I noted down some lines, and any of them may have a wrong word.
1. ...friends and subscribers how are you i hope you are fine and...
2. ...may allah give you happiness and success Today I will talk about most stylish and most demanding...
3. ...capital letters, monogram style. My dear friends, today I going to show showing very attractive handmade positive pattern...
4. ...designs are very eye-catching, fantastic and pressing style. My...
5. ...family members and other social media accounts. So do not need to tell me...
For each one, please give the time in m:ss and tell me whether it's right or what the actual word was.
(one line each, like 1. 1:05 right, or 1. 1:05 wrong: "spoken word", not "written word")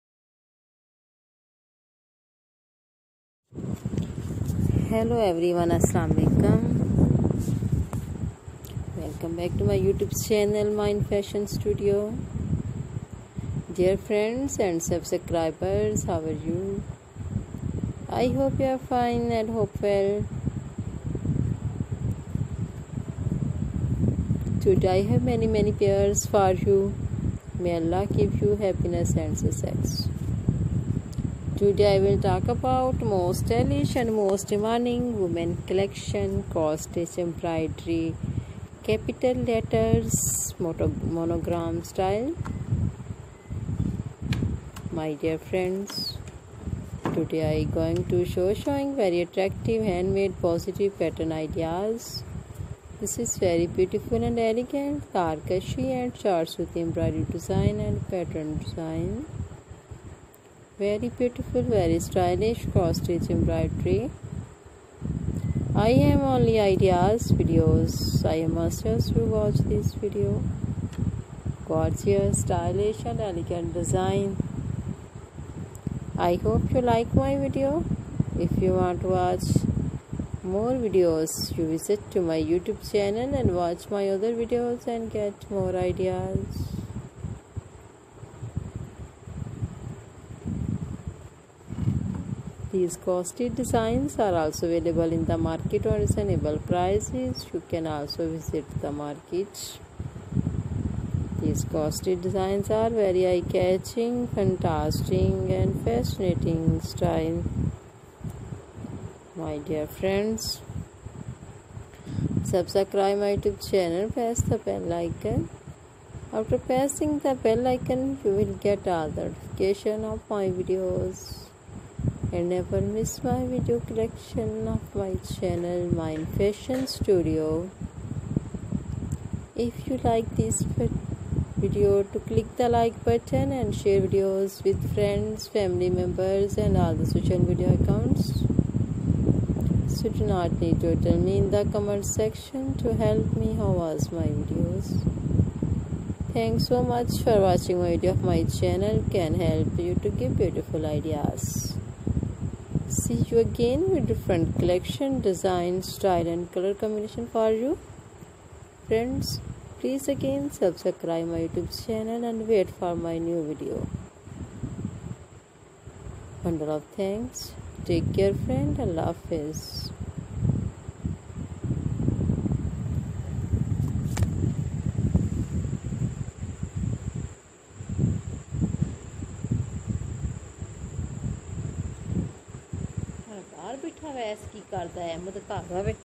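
1. 0:14 right
2. 0:27 right
3. 0:38 right
4. 1:42 wrong: "fascinating", not "pressing"
5. 2:15 right.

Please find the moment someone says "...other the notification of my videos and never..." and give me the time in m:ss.
1:58.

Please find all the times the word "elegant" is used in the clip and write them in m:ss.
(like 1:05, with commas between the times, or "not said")
0:54, 1:13.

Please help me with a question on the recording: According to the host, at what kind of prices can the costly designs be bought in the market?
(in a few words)
reasonable.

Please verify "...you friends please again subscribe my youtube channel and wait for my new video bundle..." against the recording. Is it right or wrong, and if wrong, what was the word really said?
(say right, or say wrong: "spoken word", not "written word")
right.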